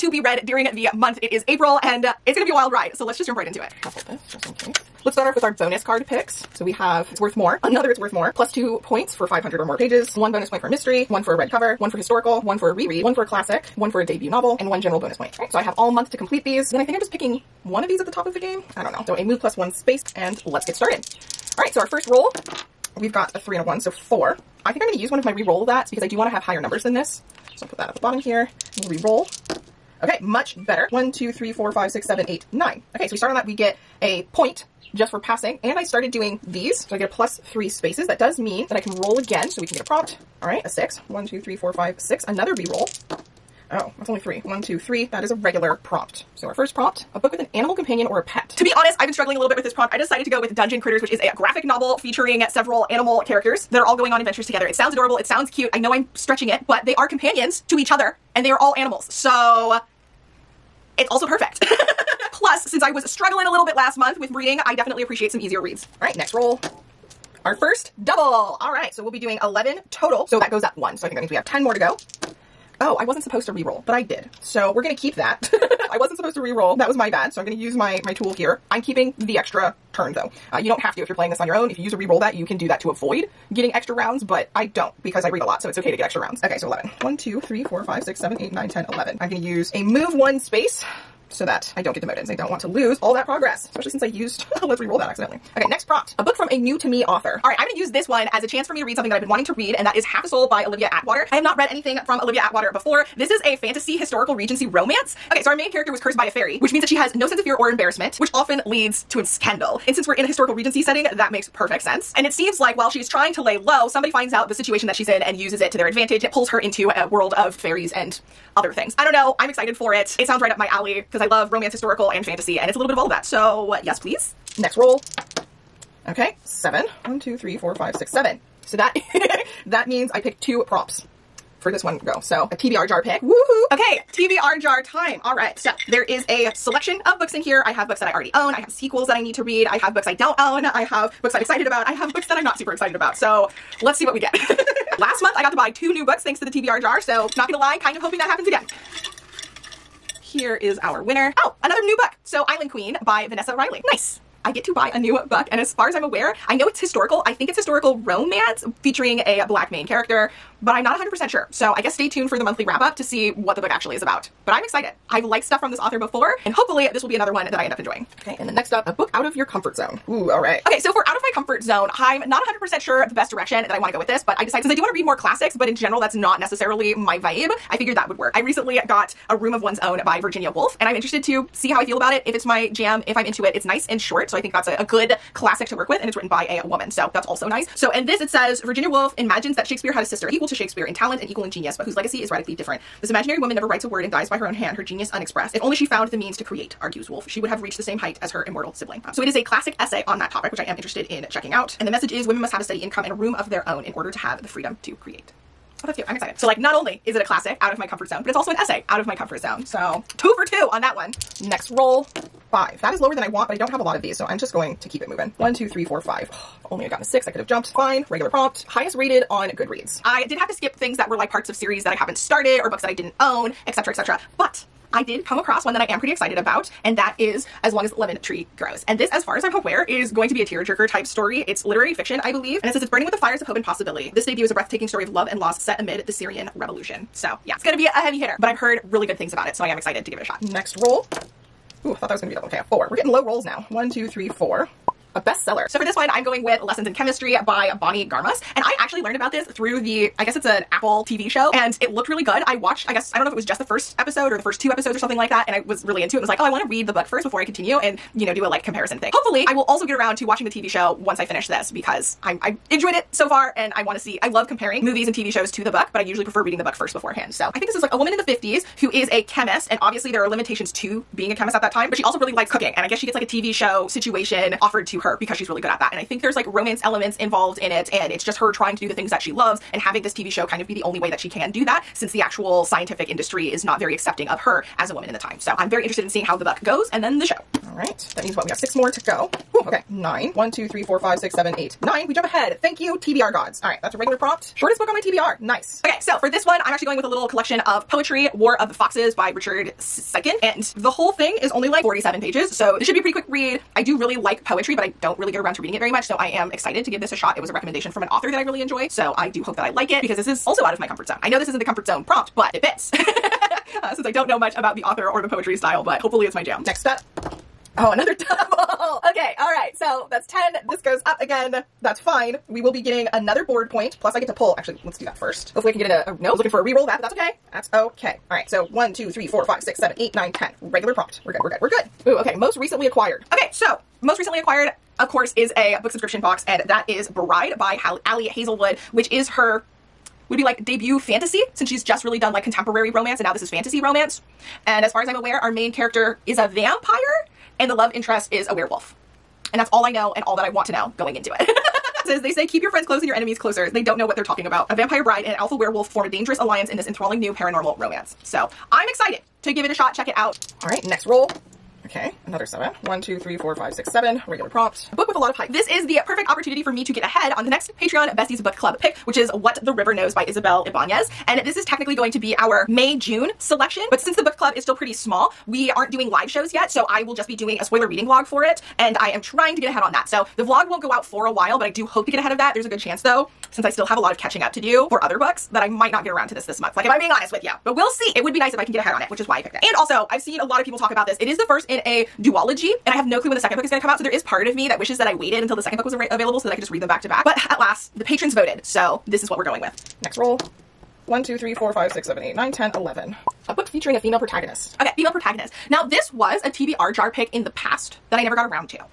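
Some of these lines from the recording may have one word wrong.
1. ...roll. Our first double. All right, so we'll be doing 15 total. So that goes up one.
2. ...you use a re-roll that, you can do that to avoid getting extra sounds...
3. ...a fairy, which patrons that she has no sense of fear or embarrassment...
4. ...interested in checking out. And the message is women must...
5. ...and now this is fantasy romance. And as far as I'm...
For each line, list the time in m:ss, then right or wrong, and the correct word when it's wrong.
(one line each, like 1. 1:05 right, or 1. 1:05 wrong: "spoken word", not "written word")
1. 1:06 wrong: "11", not "15"
2. 1:21 wrong: "rounds", not "sounds"
3. 1:46 wrong: "means", not "patrons"
4. 3:20 right
5. 5:43 right.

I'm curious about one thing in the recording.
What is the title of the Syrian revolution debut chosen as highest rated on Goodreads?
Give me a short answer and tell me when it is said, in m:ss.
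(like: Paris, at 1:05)
As Long as Lemon Tree Grows, at 3:47.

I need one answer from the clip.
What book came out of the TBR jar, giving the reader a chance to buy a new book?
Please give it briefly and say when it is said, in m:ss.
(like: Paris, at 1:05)
Island Queen, at 2:32.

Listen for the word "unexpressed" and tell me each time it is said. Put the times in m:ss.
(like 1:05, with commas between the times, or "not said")
3:15.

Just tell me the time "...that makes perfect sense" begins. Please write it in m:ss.
1:51.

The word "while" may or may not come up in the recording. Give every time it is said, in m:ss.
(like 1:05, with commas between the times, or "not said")
1:52, 6:21.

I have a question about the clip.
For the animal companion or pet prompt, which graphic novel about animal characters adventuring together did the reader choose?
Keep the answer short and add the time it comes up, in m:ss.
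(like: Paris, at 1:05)
Dungeon Critters, at 0:50.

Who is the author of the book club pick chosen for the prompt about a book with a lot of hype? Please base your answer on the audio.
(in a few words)
Isabel Ibanez.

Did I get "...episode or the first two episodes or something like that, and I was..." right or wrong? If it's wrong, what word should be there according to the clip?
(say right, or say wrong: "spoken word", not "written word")
right.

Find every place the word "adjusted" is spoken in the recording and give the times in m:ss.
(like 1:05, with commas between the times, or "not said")
not said.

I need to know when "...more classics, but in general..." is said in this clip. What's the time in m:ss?
2:55.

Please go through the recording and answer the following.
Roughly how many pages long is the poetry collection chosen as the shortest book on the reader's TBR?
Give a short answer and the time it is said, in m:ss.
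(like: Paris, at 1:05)
47, at 5:01.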